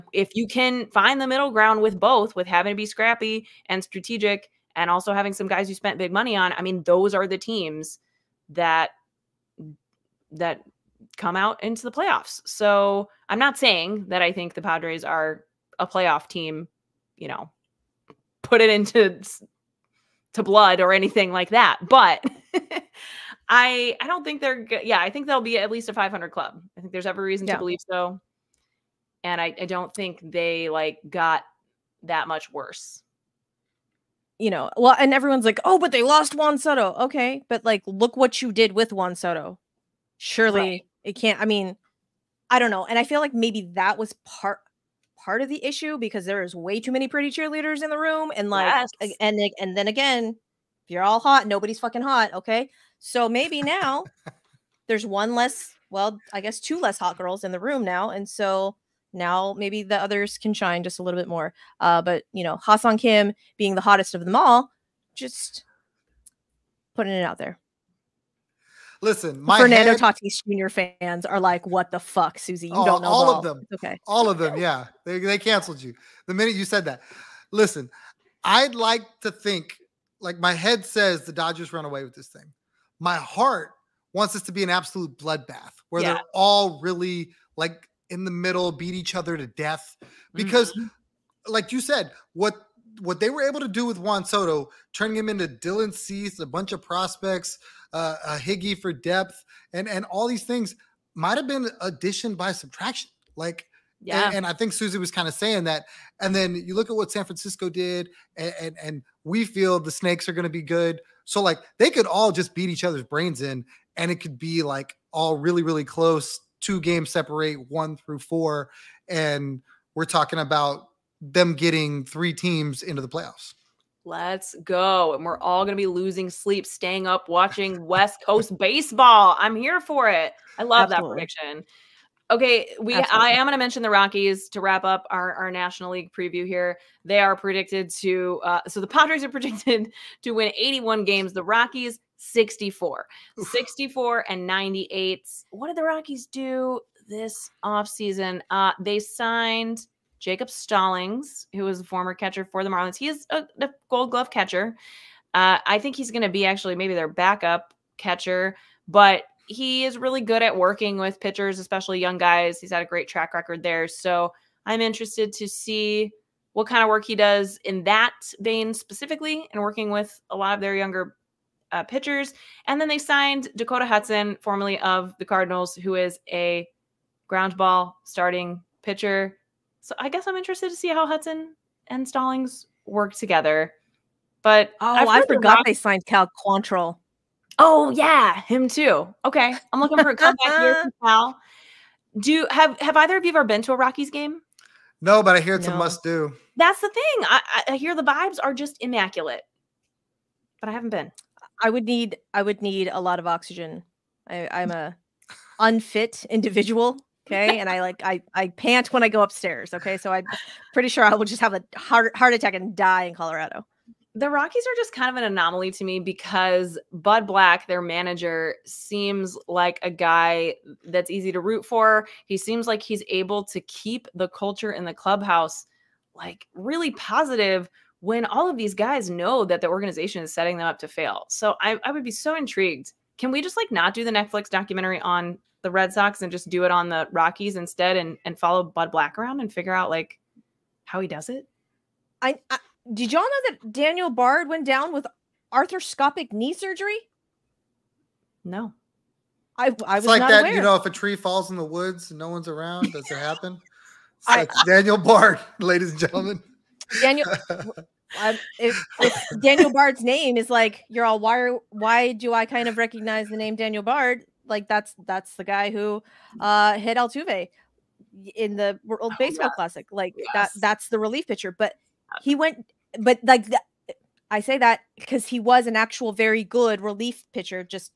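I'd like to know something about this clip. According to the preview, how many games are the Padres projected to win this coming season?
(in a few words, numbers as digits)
81.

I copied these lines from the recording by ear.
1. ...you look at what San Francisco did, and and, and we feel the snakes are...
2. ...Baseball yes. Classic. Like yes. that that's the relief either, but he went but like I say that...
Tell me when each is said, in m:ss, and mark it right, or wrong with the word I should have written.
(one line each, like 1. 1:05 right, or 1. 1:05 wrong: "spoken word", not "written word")
1. 1:46 right
2. 4:29 wrong: "pitcher", not "either".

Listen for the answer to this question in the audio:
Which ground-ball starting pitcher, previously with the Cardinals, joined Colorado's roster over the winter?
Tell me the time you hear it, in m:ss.
2:53.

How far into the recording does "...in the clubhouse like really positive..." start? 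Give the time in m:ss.
3:44.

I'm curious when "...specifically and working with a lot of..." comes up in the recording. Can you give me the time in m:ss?
2:48.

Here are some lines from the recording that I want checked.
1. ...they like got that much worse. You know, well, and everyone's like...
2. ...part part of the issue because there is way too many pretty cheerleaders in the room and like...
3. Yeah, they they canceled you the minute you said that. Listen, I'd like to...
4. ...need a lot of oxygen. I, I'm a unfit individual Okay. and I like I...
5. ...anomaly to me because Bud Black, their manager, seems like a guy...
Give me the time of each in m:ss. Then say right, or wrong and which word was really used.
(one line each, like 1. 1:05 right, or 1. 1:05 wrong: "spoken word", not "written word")
1. 0:30 right
2. 0:44 right
3. 1:14 right
4. 3:22 right
5. 3:35 right.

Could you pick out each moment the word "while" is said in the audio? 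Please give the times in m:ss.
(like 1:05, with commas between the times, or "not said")
not said.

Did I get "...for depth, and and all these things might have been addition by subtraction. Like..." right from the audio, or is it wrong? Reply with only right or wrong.
right.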